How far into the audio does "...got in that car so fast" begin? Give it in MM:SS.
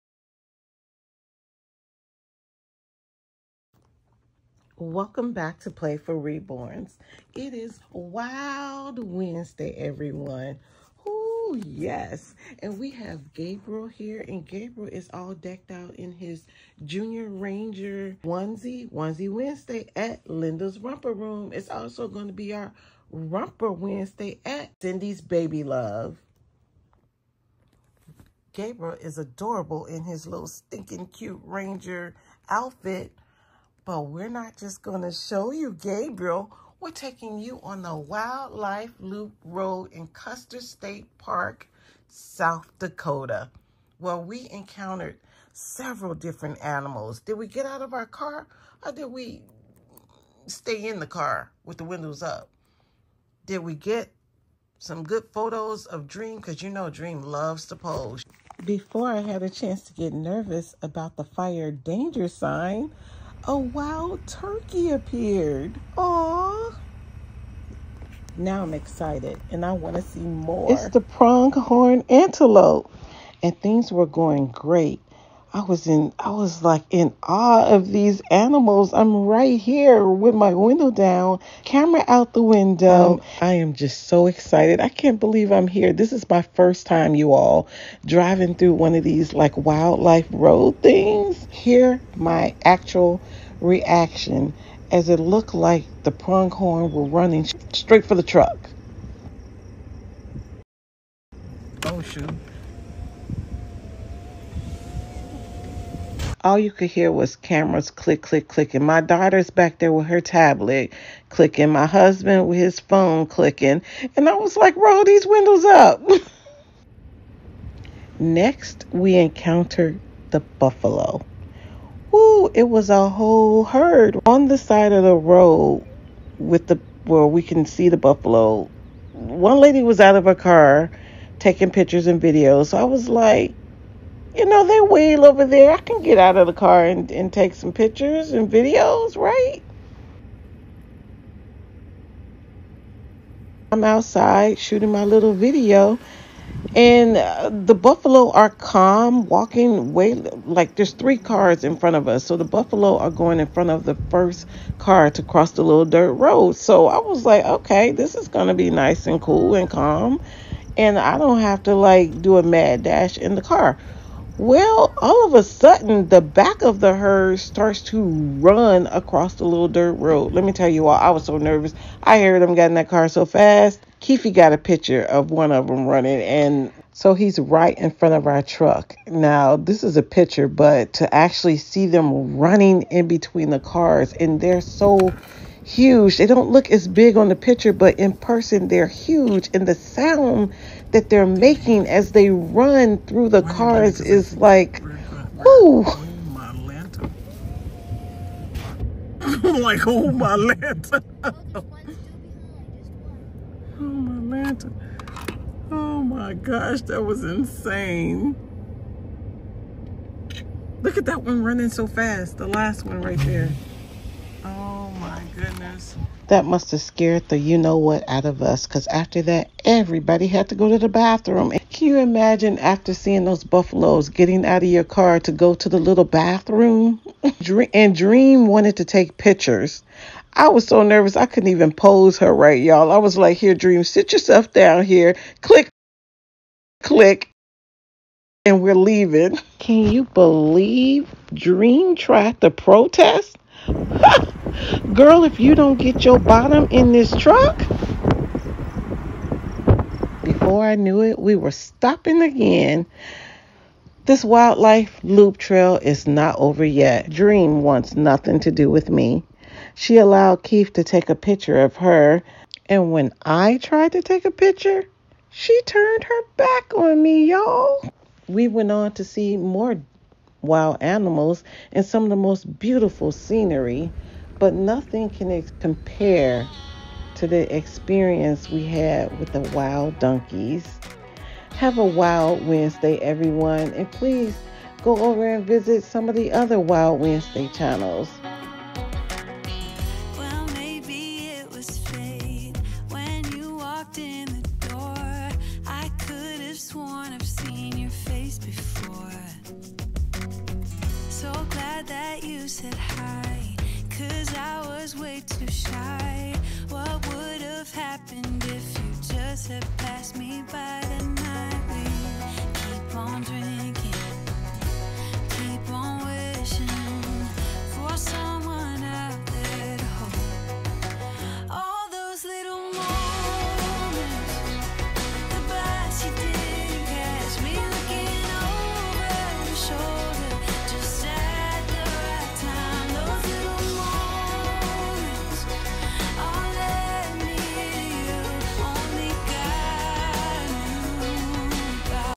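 02:52.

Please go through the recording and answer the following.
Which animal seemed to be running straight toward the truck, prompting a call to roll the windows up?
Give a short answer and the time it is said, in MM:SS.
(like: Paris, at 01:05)
pronghorn antelope, at 01:11.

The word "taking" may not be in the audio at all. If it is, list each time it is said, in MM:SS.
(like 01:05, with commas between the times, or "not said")
00:36, 02:11.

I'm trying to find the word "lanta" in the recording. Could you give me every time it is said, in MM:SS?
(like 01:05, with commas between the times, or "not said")
03:20, 03:24.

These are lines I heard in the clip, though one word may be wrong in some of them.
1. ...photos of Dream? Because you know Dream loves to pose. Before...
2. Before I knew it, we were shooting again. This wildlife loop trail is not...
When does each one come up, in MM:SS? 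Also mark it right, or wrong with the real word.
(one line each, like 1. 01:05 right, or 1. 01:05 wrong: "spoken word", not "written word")
1. 00:55 right
2. 04:10 wrong: "stopping", not "shooting".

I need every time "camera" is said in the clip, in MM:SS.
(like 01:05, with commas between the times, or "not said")
01:21, 01:47.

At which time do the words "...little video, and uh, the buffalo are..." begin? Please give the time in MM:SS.
02:25.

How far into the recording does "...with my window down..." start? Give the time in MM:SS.
01:20.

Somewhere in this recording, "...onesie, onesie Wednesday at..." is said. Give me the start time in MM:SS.
00:18.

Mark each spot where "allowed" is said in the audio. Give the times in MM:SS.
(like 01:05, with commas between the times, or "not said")
04:19.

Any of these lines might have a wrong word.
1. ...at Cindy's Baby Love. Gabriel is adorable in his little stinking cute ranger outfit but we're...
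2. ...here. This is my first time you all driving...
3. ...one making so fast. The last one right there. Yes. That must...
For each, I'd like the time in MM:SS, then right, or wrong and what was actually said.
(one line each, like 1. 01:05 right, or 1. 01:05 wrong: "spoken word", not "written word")
1. 00:24 right
2. 01:25 right
3. 03:31 wrong: "running", not "making".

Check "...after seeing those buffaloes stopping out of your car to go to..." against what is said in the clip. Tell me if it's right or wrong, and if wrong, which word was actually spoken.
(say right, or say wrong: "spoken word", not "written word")
wrong: "getting", not "stopping".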